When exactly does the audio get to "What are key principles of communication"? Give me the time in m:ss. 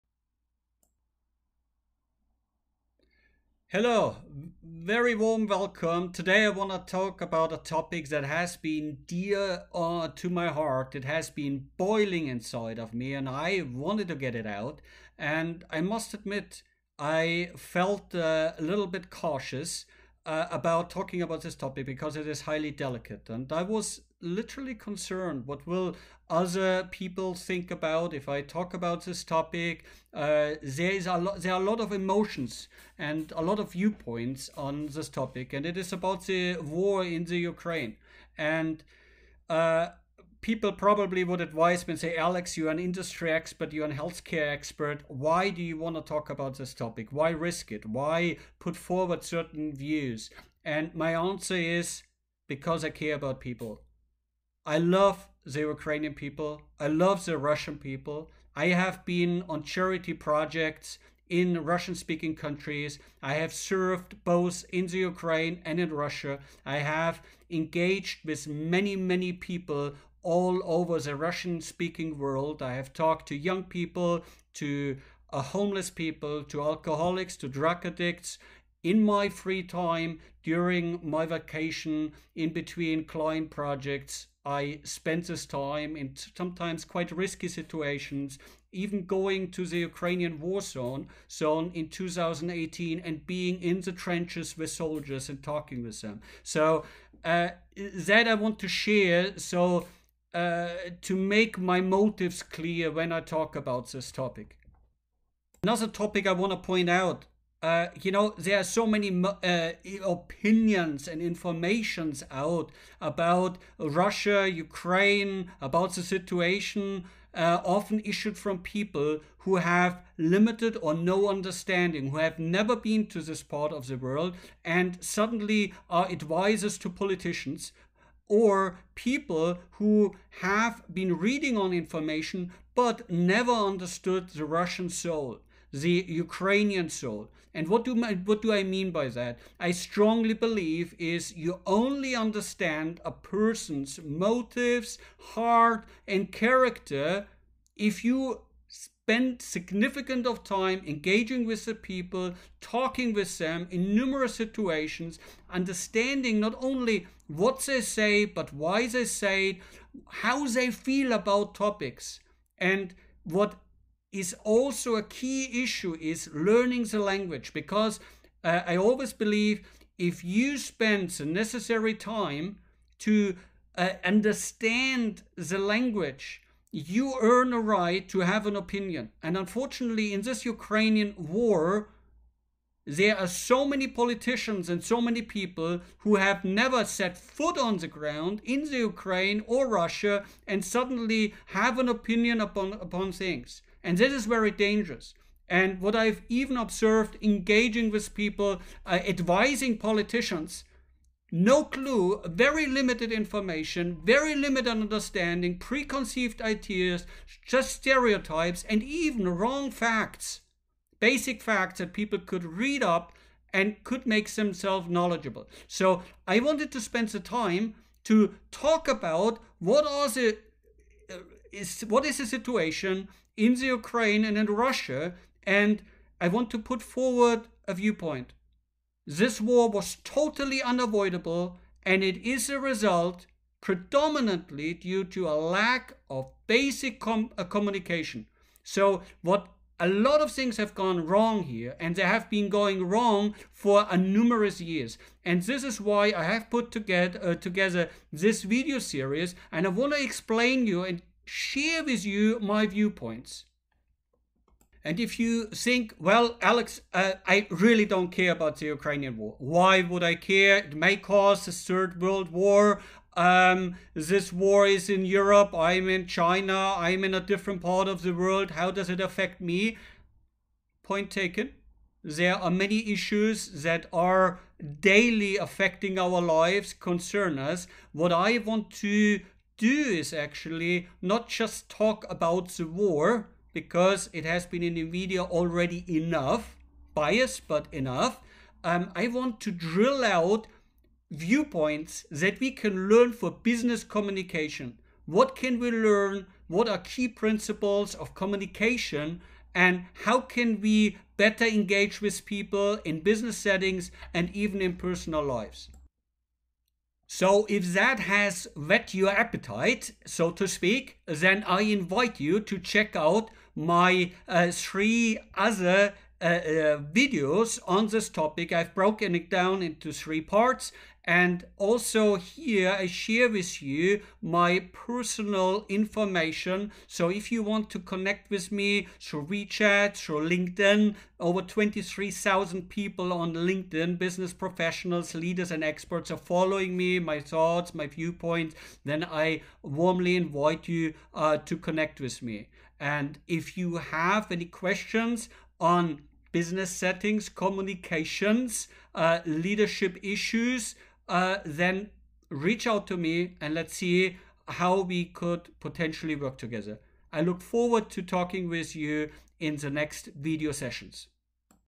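4:56.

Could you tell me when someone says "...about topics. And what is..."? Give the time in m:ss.
2:41.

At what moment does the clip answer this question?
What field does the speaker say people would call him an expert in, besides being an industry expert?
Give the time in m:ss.
0:43.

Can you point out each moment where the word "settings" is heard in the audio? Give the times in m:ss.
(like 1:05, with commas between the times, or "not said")
5:03, 5:46.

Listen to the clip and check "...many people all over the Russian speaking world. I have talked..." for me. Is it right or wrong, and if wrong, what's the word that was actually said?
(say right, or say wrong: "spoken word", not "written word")
right.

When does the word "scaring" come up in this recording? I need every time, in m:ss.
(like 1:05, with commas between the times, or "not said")
not said.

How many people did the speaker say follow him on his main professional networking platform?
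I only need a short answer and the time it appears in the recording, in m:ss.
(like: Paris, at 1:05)
23,000, at 5:31.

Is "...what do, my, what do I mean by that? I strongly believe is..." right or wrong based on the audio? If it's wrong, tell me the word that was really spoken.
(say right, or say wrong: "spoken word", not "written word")
right.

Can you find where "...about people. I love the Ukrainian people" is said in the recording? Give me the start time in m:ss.
0:53.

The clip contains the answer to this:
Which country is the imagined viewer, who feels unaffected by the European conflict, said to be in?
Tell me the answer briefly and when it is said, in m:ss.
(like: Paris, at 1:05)
China, at 4:26.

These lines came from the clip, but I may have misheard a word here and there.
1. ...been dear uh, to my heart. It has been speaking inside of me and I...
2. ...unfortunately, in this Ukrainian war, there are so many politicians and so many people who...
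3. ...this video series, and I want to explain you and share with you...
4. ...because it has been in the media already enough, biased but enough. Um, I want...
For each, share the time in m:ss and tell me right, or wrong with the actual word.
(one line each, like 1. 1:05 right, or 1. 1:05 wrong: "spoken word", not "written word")
1. 0:08 wrong: "boiling", not "speaking"
2. 2:59 right
3. 4:08 right
4. 4:43 right.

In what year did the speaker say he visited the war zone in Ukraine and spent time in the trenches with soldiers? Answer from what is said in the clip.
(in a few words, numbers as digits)
2018.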